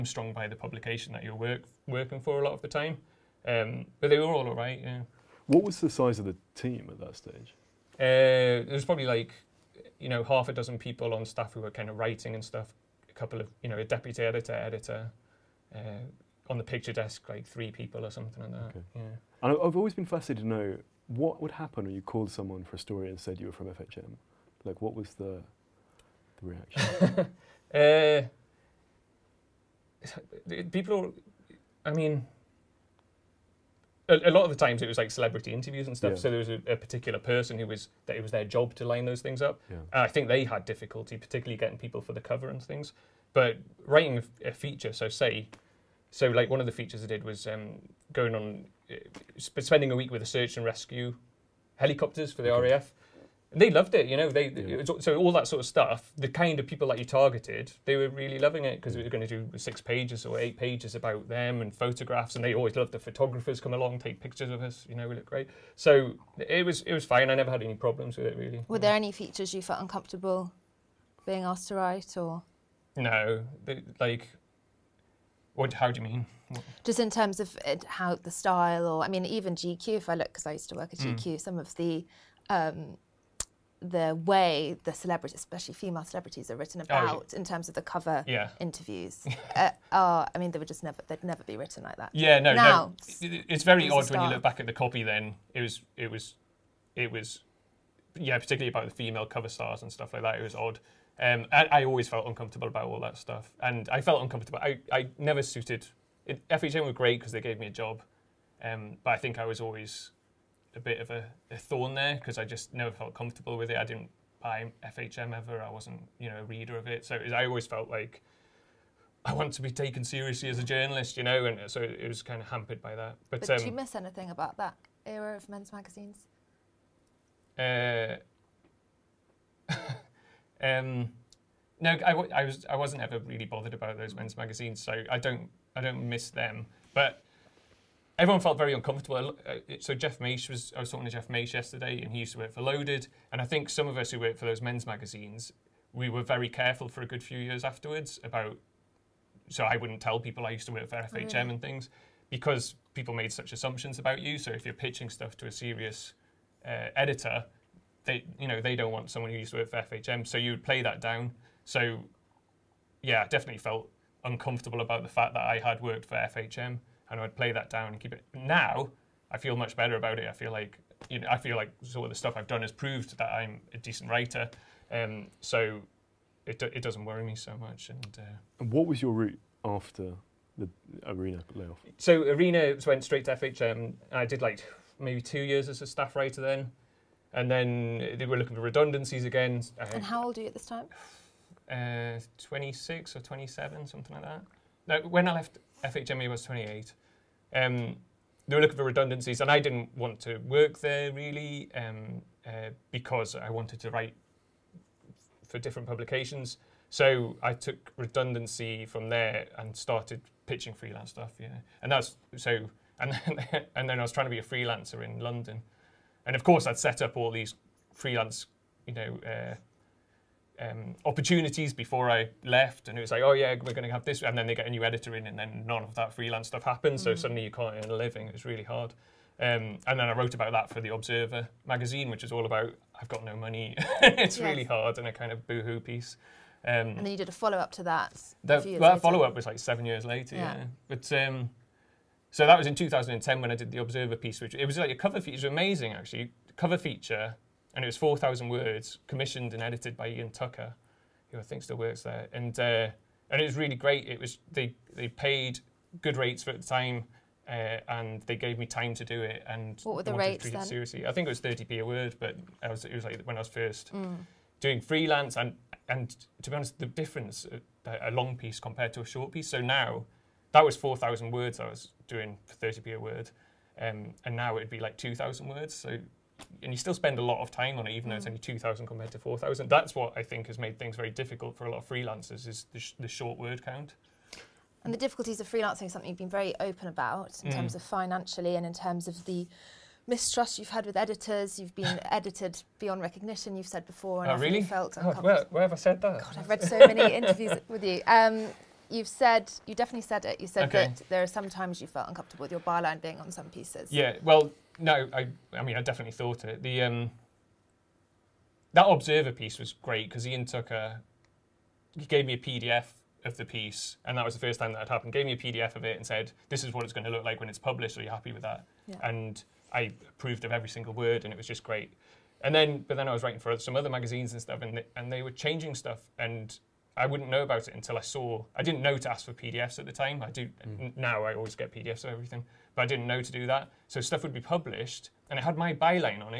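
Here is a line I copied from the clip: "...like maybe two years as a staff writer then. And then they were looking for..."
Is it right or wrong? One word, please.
right.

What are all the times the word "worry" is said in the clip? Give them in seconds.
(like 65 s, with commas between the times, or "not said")
177 s.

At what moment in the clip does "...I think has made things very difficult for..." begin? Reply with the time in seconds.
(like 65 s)
280 s.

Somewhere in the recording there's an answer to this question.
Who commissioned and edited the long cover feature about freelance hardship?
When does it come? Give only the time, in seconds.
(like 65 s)
250 s.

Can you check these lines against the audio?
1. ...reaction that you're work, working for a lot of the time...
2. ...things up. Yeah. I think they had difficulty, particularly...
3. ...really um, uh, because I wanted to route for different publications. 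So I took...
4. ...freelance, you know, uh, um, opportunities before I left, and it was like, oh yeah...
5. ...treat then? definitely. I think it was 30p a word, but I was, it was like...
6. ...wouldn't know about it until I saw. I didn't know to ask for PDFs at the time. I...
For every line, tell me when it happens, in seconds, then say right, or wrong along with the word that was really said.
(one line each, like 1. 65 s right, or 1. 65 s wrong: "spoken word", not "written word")
1. 0 s wrong: "publication", not "reaction"
2. 39 s right
3. 201 s wrong: "write", not "route"
4. 217 s right
5. 260 s wrong: "seriously", not "definitely"
6. 327 s right.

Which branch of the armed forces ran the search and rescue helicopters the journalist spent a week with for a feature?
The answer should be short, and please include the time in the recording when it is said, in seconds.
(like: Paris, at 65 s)
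RAF, at 52 s.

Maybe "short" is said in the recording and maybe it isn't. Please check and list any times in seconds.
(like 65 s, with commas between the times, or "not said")
269 s, 283 s.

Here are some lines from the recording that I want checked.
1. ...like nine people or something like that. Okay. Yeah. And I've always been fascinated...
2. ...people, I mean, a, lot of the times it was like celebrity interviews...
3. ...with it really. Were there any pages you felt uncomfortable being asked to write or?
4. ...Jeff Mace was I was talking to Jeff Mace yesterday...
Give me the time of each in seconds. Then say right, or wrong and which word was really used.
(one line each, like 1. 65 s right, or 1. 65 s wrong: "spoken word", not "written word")
1. 17 s wrong: "three", not "nine"
2. 30 s right
3. 68 s wrong: "features", not "pages"
4. 139 s right.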